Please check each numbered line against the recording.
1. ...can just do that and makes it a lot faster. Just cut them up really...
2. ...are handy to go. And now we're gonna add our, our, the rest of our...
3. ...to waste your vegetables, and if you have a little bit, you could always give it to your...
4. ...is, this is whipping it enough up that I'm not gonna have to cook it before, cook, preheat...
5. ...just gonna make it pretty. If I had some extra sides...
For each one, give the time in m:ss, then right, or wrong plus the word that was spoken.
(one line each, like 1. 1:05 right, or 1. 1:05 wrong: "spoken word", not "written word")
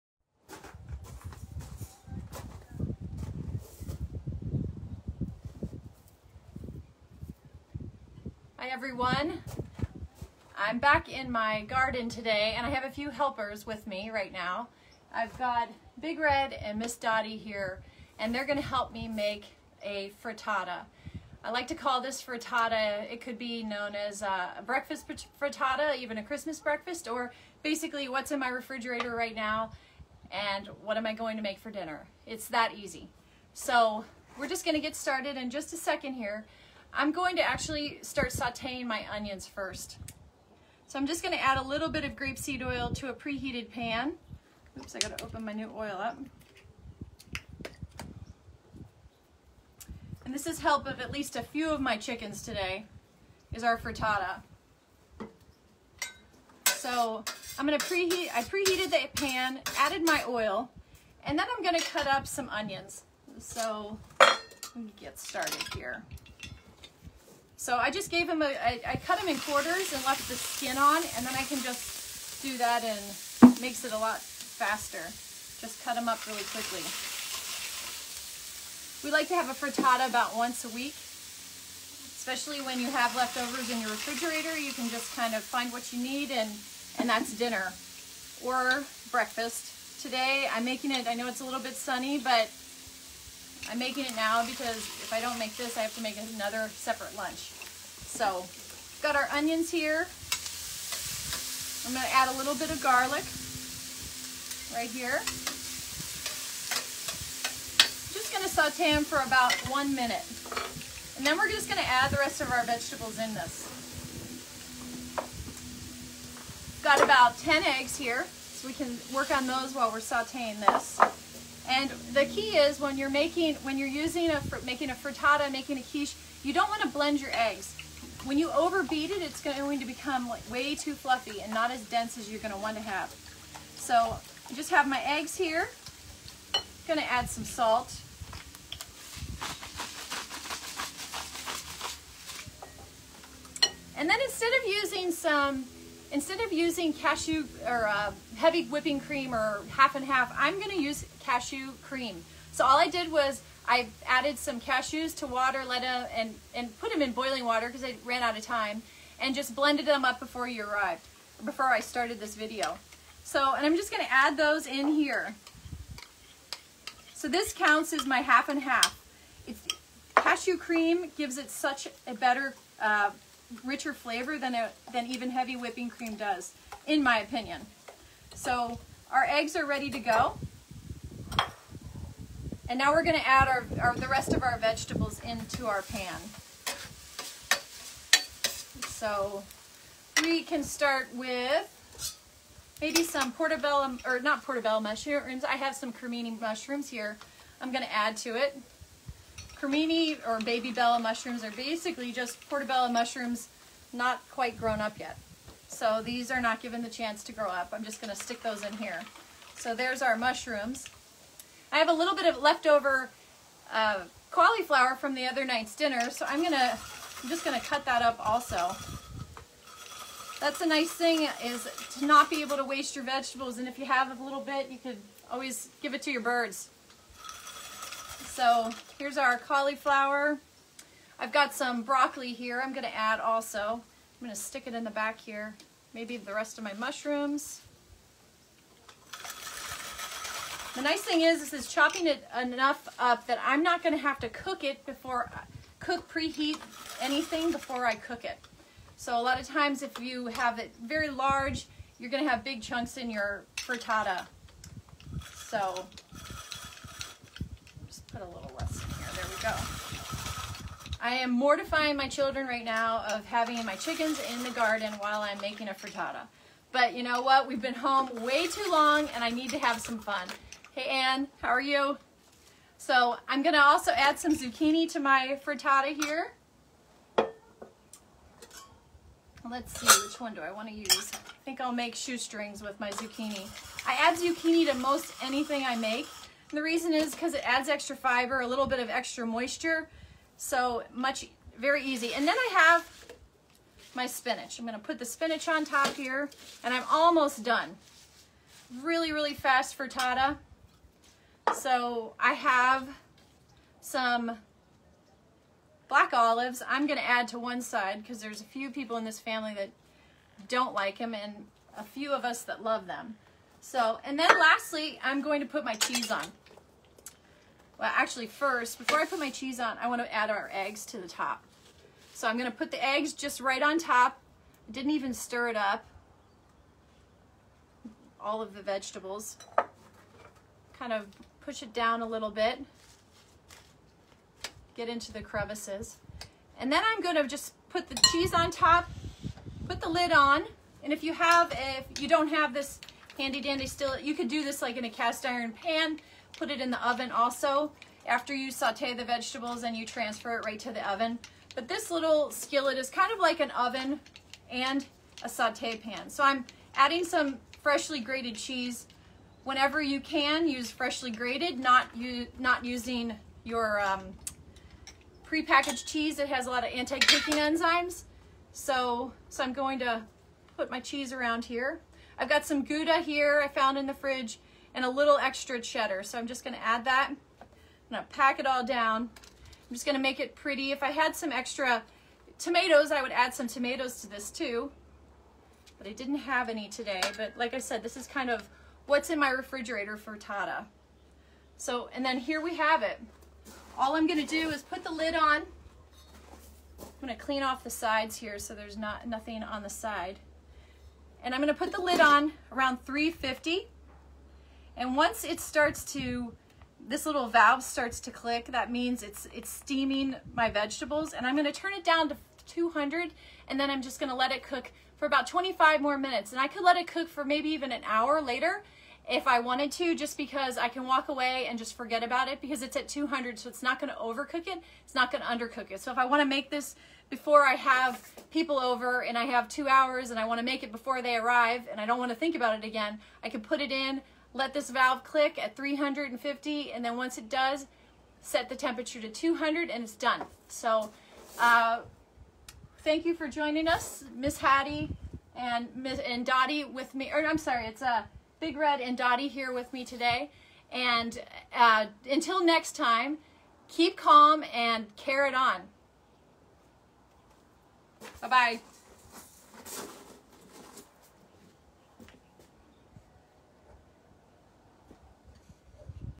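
1. 1:11 right
2. 2:59 wrong: "ready", not "handy"
3. 3:42 right
4. 4:01 wrong: "chopping", not "whipping"
5. 6:19 wrong: "tomatoes", not "sides".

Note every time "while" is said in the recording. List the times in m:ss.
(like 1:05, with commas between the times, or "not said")
1:59, 4:24.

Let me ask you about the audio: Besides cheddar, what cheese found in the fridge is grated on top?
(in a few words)
Gouda.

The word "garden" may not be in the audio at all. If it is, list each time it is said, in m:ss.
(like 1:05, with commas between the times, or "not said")
0:11, 4:24.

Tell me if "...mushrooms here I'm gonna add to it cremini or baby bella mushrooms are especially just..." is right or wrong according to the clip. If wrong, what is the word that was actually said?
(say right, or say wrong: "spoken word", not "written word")
wrong: "basically", not "especially".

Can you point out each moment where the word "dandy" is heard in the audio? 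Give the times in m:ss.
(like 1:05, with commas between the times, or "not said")
5:43.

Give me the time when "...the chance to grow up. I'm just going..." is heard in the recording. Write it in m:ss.
3:26.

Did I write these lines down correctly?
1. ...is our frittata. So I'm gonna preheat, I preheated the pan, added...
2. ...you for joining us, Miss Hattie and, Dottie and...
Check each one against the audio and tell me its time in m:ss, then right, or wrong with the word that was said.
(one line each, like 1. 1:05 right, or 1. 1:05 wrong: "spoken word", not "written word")
1. 0:53 right
2. 7:23 wrong: "Miss", not "Dottie".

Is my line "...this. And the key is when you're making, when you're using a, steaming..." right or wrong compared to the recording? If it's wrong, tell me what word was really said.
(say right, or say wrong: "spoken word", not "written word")
wrong: "making", not "steaming".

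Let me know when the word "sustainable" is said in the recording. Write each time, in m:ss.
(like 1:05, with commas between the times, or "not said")
not said.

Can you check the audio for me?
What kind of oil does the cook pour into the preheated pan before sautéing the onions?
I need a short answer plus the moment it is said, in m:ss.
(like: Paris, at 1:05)
grapeseed oil, at 0:42.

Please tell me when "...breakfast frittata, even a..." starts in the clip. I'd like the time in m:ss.
0:24.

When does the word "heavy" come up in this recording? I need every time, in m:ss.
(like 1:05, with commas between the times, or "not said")
2:28, 2:55.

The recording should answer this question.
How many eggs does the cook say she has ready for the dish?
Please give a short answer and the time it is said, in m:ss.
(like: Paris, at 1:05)
10, at 1:57.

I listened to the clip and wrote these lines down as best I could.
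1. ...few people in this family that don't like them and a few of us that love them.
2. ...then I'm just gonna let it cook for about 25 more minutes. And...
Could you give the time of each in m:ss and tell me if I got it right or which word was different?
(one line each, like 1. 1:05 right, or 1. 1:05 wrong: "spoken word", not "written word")
1. 5:08 right
2. 6:53 right.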